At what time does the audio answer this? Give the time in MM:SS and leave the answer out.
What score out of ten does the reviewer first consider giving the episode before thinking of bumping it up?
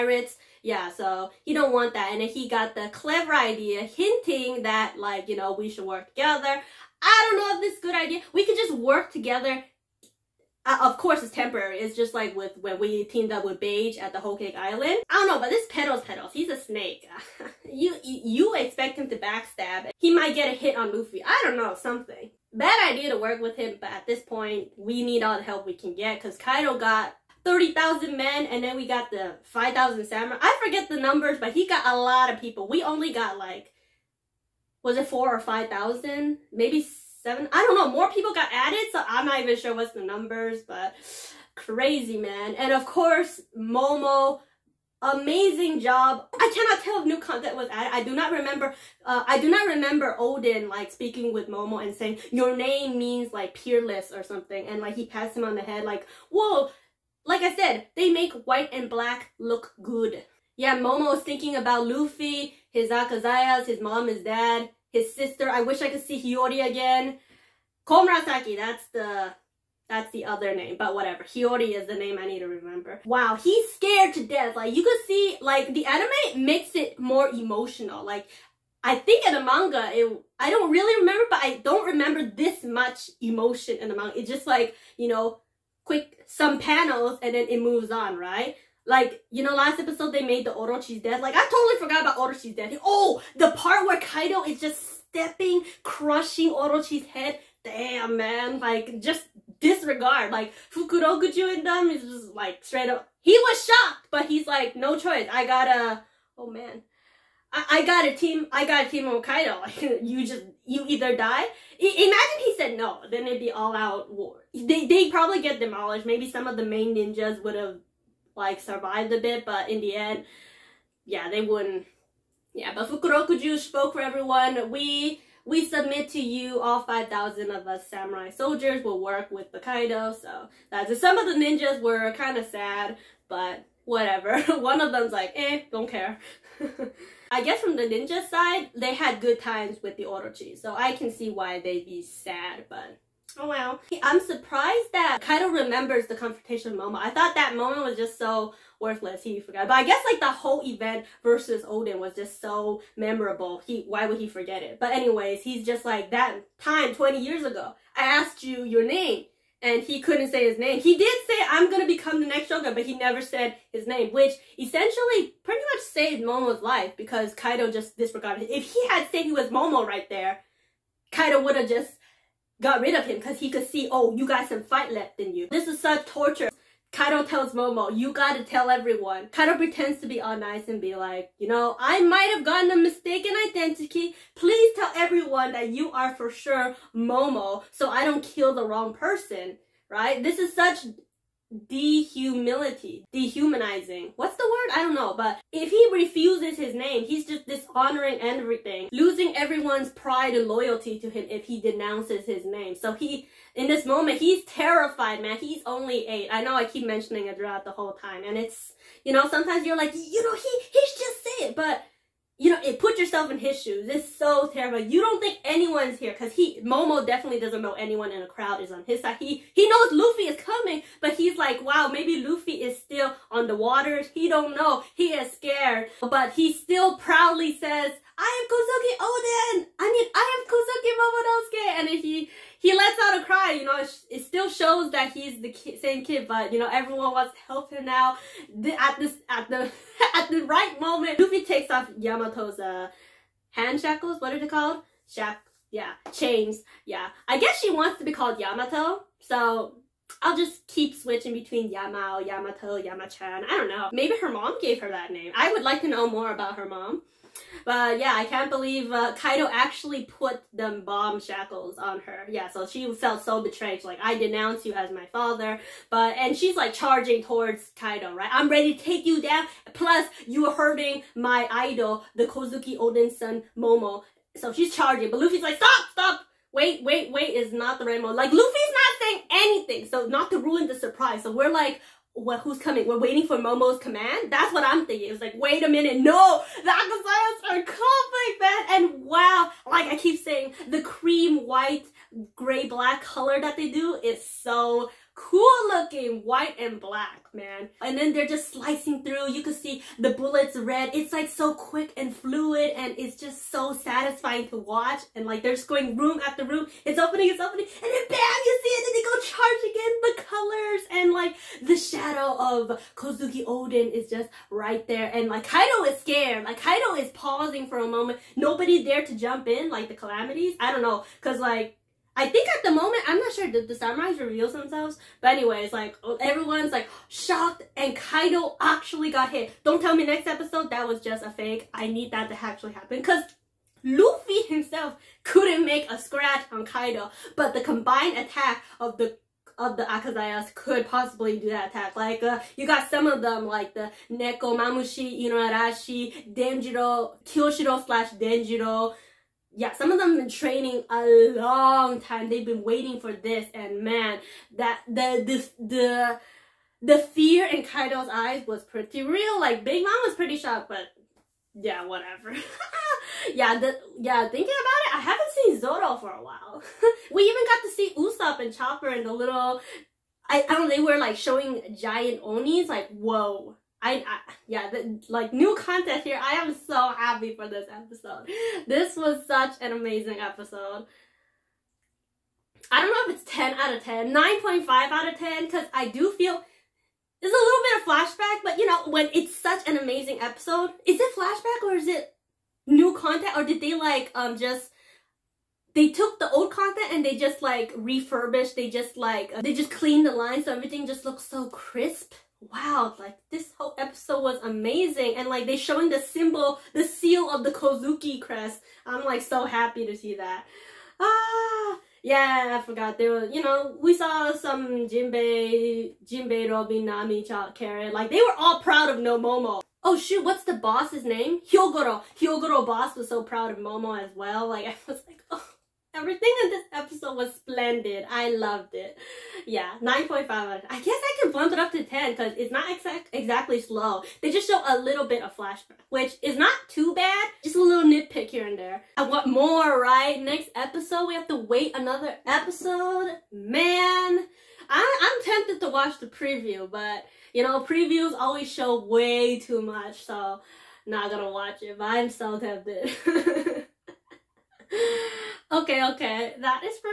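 06:24.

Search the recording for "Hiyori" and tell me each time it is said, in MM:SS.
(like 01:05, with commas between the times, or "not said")
01:06, 01:11.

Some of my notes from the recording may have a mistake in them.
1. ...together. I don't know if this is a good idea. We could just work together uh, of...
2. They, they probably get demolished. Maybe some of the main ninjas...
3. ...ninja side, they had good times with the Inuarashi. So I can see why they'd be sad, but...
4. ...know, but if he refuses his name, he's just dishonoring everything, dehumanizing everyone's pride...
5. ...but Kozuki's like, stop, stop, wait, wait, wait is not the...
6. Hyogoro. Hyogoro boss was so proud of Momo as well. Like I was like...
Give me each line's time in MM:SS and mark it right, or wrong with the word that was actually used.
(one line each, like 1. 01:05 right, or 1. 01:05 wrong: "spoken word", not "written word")
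1. 00:06 right
2. 01:54 right
3. 02:17 wrong: "Orochi", not "Inuarashi"
4. 03:14 wrong: "losing", not "dehumanizing"
5. 04:35 wrong: "Luffy", not "Kozuki"
6. 07:01 right.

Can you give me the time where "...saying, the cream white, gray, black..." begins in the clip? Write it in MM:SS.
04:50.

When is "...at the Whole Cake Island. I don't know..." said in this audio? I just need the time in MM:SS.
00:13.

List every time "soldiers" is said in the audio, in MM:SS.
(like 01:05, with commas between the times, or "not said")
02:08.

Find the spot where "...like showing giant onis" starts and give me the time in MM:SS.
06:10.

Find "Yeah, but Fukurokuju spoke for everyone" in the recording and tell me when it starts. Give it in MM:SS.
02:02.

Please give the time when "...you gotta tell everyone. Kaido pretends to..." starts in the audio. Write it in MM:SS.
02:57.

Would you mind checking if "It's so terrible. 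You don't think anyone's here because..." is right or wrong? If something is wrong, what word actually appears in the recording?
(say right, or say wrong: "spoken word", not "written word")
right.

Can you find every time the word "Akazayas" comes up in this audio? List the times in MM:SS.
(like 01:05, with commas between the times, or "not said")
01:02, 04:46, 05:39.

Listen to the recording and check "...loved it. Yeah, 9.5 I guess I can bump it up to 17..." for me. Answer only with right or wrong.
wrong.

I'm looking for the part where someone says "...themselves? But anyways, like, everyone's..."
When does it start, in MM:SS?
05:24.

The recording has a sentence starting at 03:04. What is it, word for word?
Please tell everyone that you are for sure Momo so I don't kill the wrong person, right?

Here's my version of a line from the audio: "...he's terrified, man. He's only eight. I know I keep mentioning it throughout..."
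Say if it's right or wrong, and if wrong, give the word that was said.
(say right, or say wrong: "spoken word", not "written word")
right.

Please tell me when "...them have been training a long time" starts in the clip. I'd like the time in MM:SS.
05:49.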